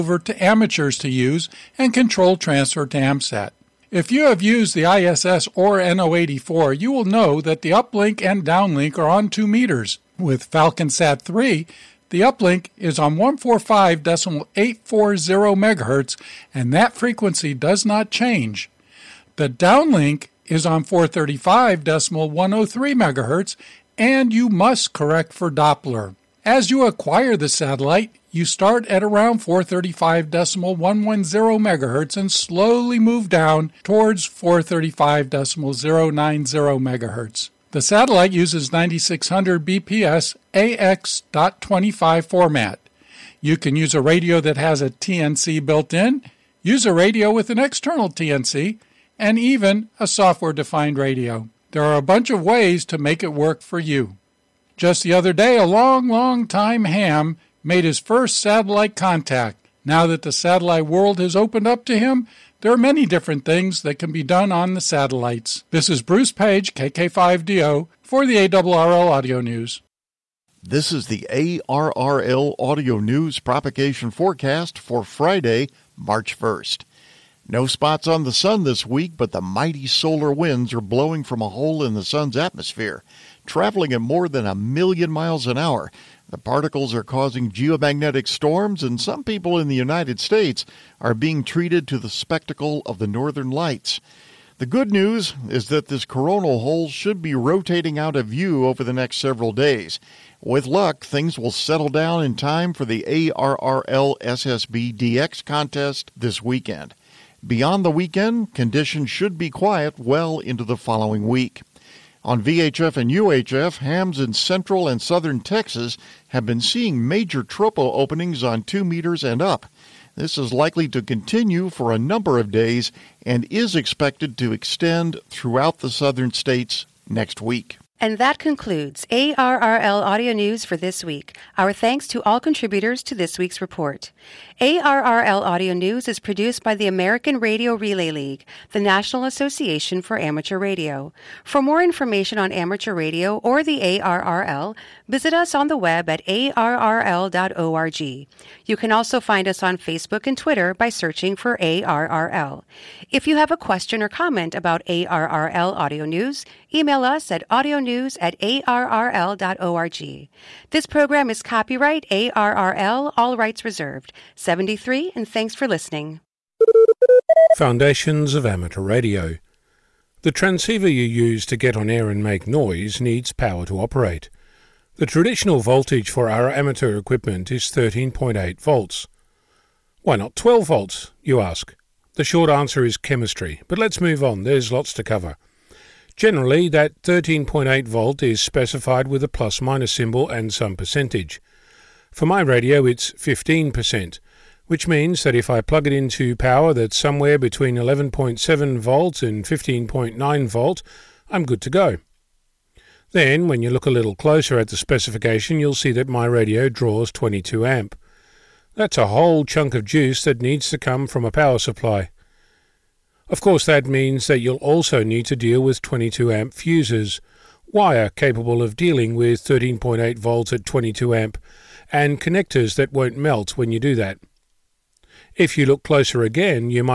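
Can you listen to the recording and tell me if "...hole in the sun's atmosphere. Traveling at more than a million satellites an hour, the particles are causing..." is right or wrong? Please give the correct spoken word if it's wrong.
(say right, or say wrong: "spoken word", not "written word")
wrong: "miles", not "satellites".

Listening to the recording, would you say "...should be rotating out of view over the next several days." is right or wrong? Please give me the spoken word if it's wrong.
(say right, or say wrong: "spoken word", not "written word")
right.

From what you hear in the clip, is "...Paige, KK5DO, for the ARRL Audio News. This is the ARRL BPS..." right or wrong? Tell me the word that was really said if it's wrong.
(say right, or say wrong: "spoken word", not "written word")
wrong: "Audio", not "BPS".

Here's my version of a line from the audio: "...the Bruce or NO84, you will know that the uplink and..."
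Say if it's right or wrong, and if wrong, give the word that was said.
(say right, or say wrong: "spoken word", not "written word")
wrong: "ISS", not "Bruce".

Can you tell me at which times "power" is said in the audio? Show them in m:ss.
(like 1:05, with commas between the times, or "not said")
2:53, 3:16, 3:31.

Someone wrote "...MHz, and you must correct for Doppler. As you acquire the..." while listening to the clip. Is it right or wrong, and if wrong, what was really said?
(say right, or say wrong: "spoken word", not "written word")
right.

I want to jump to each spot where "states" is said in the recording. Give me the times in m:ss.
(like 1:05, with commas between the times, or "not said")
1:30, 2:06.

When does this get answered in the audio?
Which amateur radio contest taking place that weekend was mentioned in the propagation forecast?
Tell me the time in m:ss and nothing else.
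1:43.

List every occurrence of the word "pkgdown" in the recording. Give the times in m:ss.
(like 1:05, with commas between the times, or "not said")
not said.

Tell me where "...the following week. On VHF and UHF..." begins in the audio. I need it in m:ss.
1:50.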